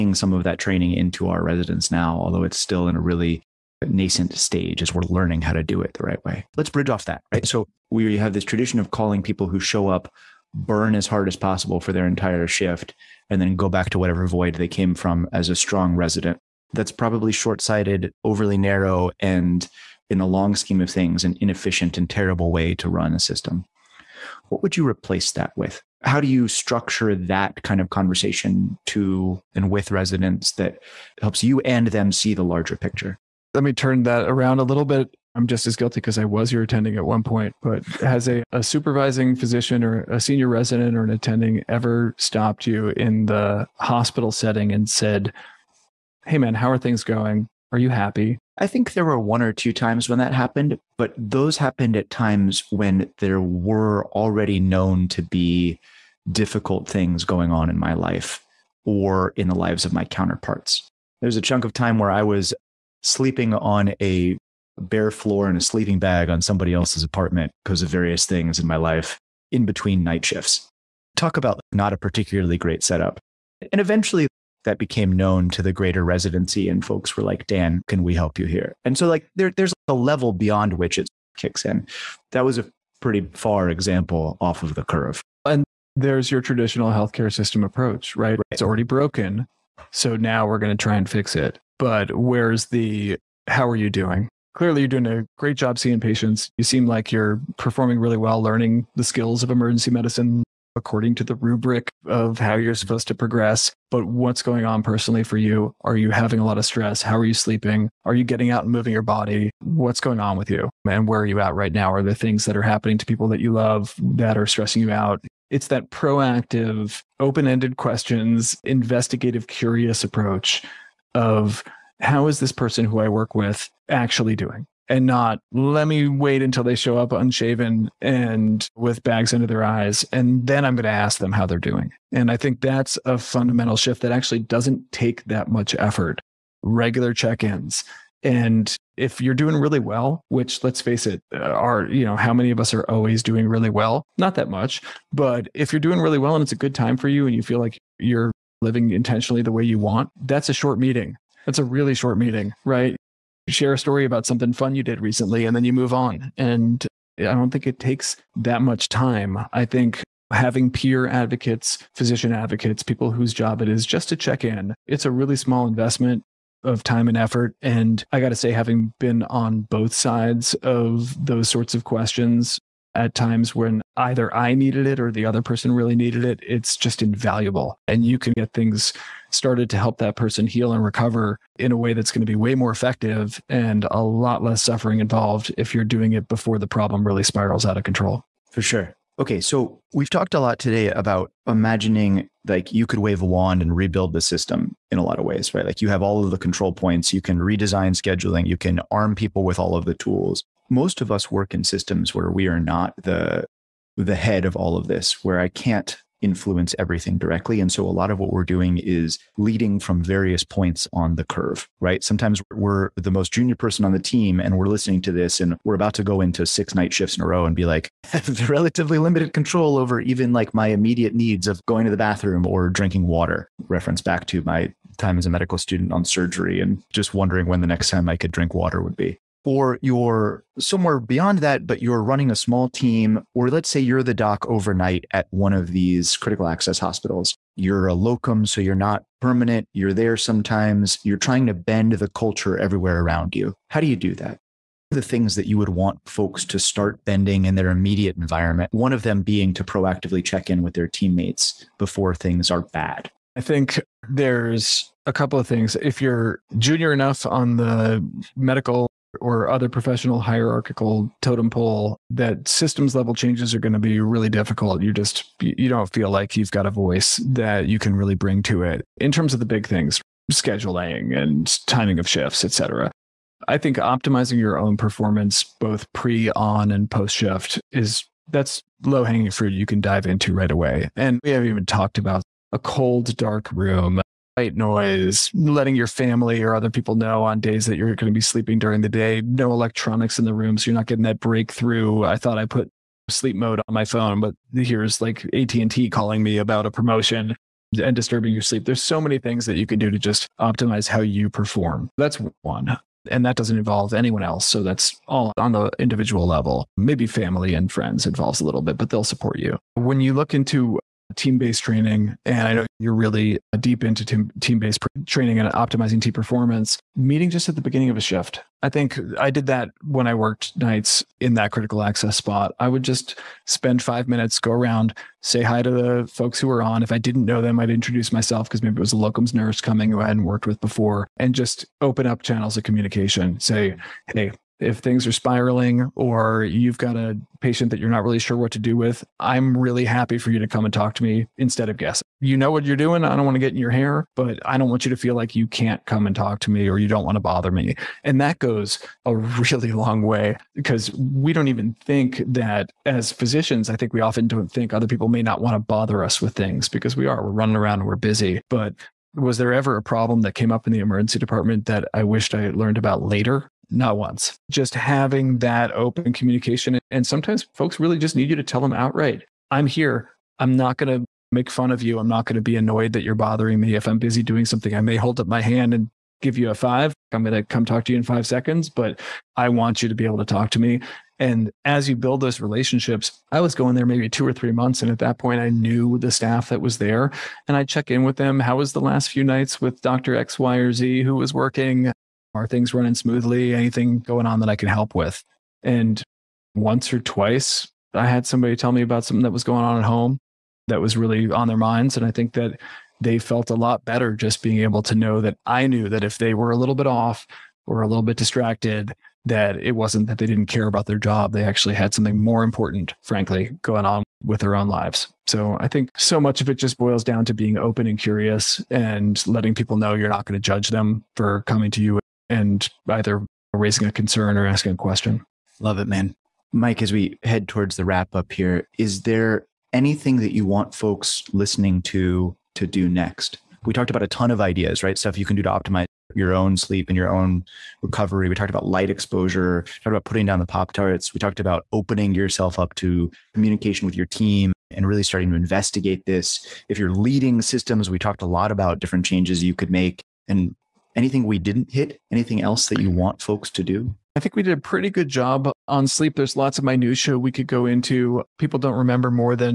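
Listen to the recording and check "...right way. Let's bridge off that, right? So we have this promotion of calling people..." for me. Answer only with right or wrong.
wrong.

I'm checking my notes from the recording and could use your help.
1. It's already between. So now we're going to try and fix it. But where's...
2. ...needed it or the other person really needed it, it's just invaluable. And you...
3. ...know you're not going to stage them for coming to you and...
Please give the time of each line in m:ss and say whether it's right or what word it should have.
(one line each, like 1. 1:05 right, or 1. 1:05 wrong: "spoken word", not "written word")
1. 1:28 wrong: "broken", not "between"
2. 2:54 right
3. 6:59 wrong: "judge", not "stage".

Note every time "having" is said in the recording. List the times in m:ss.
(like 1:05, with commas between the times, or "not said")
1:46, 2:40, 2:48, 6:04.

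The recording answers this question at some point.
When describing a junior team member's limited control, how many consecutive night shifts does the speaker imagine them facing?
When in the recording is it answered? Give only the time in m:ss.
3:36.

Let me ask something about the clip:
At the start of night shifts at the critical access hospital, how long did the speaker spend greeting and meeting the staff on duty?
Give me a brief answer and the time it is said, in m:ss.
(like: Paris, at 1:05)
5 minutes, at 5:23.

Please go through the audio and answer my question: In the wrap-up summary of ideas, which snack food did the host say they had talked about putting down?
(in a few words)
Pop Tarts.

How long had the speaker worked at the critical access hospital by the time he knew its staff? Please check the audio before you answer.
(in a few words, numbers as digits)
2 or 3 months.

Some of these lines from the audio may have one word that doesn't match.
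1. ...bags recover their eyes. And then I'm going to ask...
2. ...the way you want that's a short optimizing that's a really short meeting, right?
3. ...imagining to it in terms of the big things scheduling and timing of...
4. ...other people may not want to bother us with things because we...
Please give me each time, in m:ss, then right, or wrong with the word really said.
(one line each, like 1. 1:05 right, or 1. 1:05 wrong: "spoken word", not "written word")
1. 2:09 wrong: "under", not "recover"
2. 2:29 wrong: "meeting", not "optimizing"
3. 4:28 wrong: "bring", not "imagining"
4. 5:54 right.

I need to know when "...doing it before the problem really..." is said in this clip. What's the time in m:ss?
3:05.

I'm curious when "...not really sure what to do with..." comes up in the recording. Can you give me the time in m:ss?
5:37.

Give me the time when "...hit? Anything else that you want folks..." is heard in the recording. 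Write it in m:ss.
7:31.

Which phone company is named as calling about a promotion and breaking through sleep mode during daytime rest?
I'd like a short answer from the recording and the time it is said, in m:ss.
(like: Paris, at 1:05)
AT&T, at 4:55.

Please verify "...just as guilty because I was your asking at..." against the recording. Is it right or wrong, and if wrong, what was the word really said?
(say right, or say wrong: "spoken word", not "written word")
wrong: "attending", not "asking".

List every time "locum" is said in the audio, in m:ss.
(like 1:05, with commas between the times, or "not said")
3:57, 5:28.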